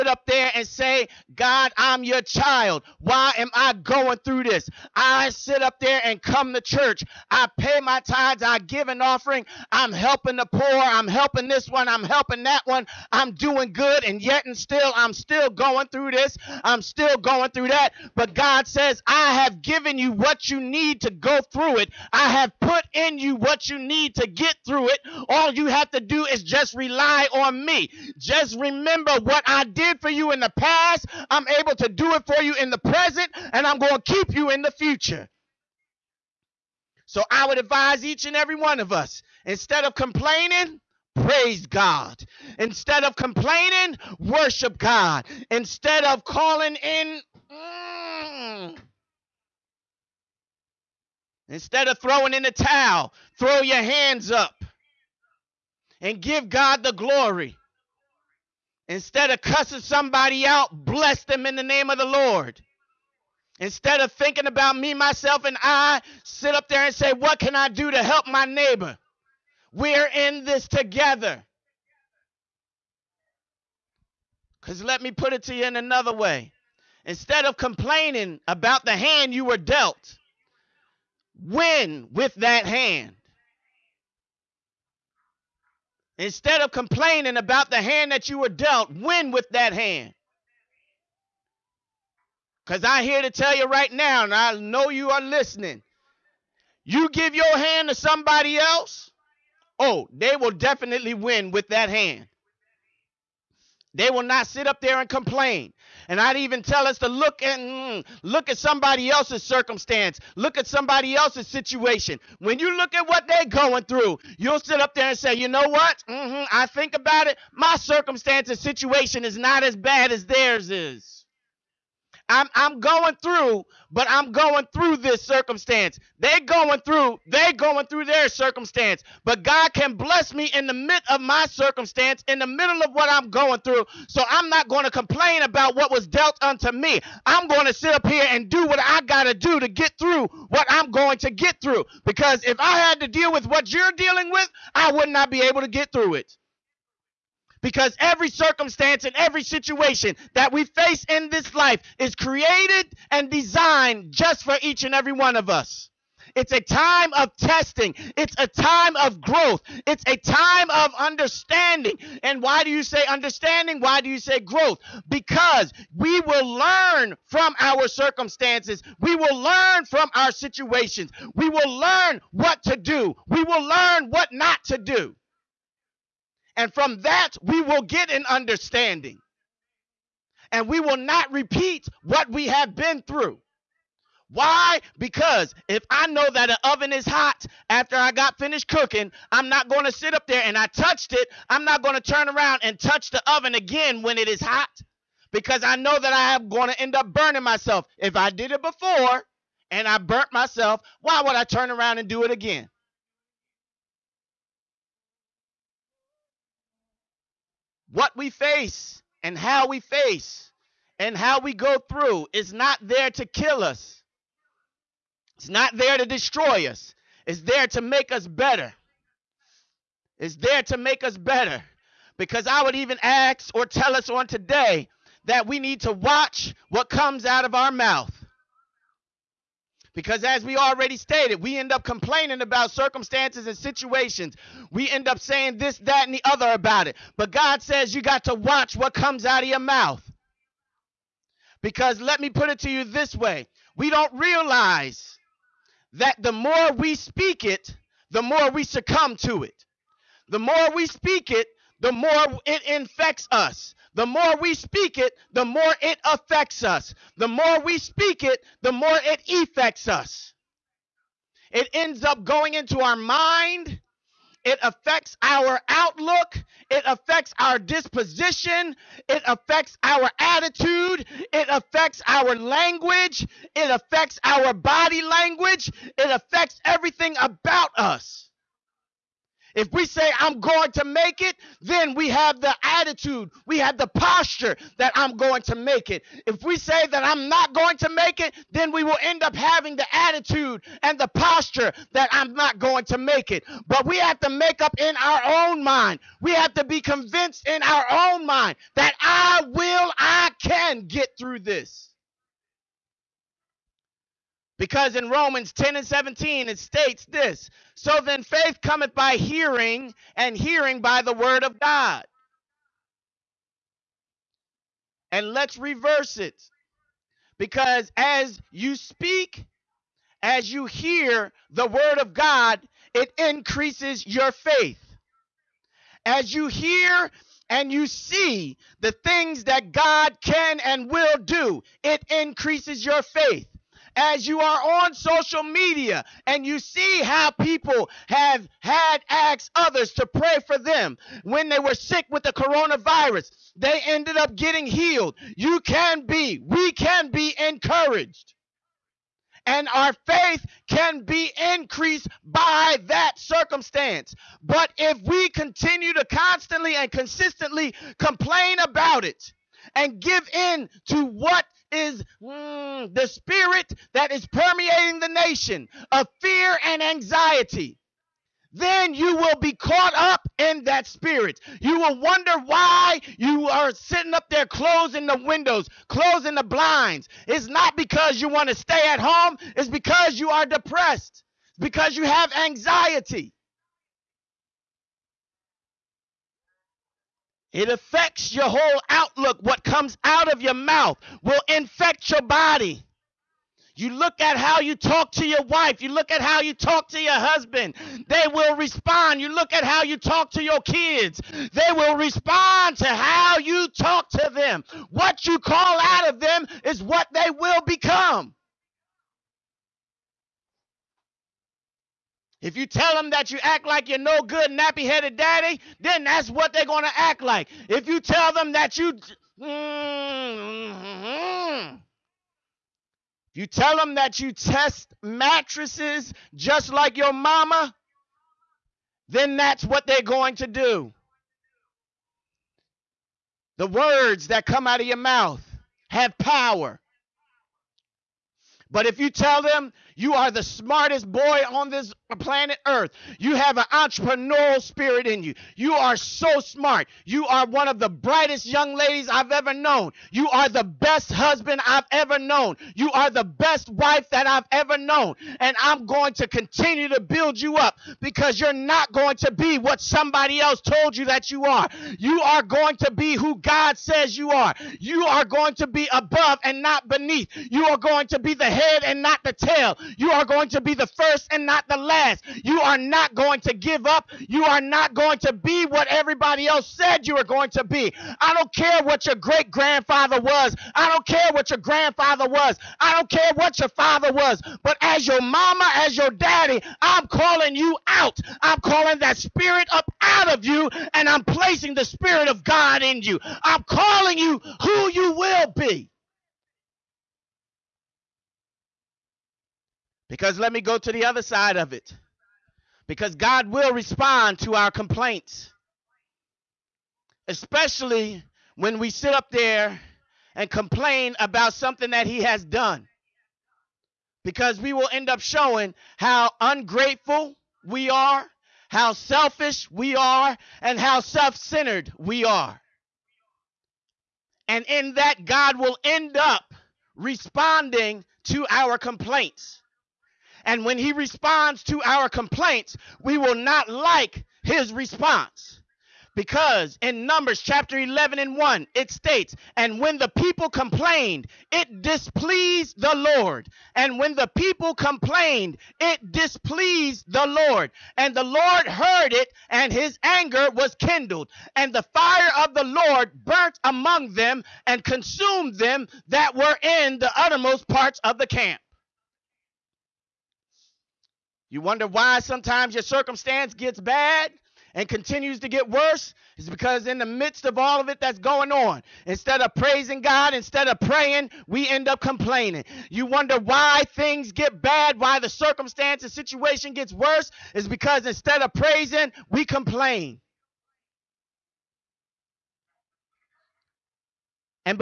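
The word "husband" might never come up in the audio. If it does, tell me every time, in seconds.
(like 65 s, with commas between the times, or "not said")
397 s, 451 s.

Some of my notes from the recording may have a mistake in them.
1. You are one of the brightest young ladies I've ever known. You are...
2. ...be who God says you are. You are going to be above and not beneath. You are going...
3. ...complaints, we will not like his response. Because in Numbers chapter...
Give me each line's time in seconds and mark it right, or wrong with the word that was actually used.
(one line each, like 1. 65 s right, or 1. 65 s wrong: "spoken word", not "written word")
1. 447 s right
2. 462 s right
3. 532 s right.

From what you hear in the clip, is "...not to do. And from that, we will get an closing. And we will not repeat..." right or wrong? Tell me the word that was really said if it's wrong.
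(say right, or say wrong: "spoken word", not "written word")
wrong: "understanding", not "closing".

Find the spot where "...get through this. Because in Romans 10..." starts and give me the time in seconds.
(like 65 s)
300 s.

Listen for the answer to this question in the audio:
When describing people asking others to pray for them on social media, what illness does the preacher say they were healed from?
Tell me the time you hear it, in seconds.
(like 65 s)
342 s.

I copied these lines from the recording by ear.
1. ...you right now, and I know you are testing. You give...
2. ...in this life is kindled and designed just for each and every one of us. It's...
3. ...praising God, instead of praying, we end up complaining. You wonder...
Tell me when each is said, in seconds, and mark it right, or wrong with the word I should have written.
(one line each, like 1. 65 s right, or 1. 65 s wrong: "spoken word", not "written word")
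1. 93 s wrong: "listening", not "testing"
2. 151 s wrong: "created", not "kindled"
3. 569 s right.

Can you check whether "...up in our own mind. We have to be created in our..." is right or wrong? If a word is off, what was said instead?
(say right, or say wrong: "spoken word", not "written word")
wrong: "convinced", not "created".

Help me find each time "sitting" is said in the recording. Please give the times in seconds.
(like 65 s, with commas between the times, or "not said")
373 s.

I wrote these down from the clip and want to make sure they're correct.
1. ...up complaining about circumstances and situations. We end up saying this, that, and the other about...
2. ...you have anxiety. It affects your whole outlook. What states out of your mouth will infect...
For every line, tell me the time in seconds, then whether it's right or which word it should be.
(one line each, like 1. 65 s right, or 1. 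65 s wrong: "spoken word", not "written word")
1. 231 s right
2. 381 s wrong: "comes", not "states".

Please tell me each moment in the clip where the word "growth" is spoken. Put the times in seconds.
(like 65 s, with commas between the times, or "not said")
159 s, 164 s.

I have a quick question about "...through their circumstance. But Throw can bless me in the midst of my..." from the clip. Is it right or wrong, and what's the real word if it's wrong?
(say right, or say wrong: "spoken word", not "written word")
wrong: "God", not "Throw".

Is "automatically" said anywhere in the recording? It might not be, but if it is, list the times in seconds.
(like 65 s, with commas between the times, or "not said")
not said.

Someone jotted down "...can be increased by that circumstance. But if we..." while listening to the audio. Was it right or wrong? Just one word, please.
right.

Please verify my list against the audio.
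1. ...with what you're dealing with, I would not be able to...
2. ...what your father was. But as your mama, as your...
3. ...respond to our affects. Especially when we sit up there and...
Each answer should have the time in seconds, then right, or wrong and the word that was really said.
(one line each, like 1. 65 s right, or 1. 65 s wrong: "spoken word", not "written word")
1. 143 s right
2. 483 s right
3. 503 s wrong: "complaints", not "affects".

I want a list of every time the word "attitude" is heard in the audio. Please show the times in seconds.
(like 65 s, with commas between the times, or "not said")
270 s, 282 s, 289 s.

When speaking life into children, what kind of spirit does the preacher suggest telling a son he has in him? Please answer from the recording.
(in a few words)
Entrepreneurial spirit.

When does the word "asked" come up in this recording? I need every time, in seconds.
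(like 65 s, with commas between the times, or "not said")
339 s.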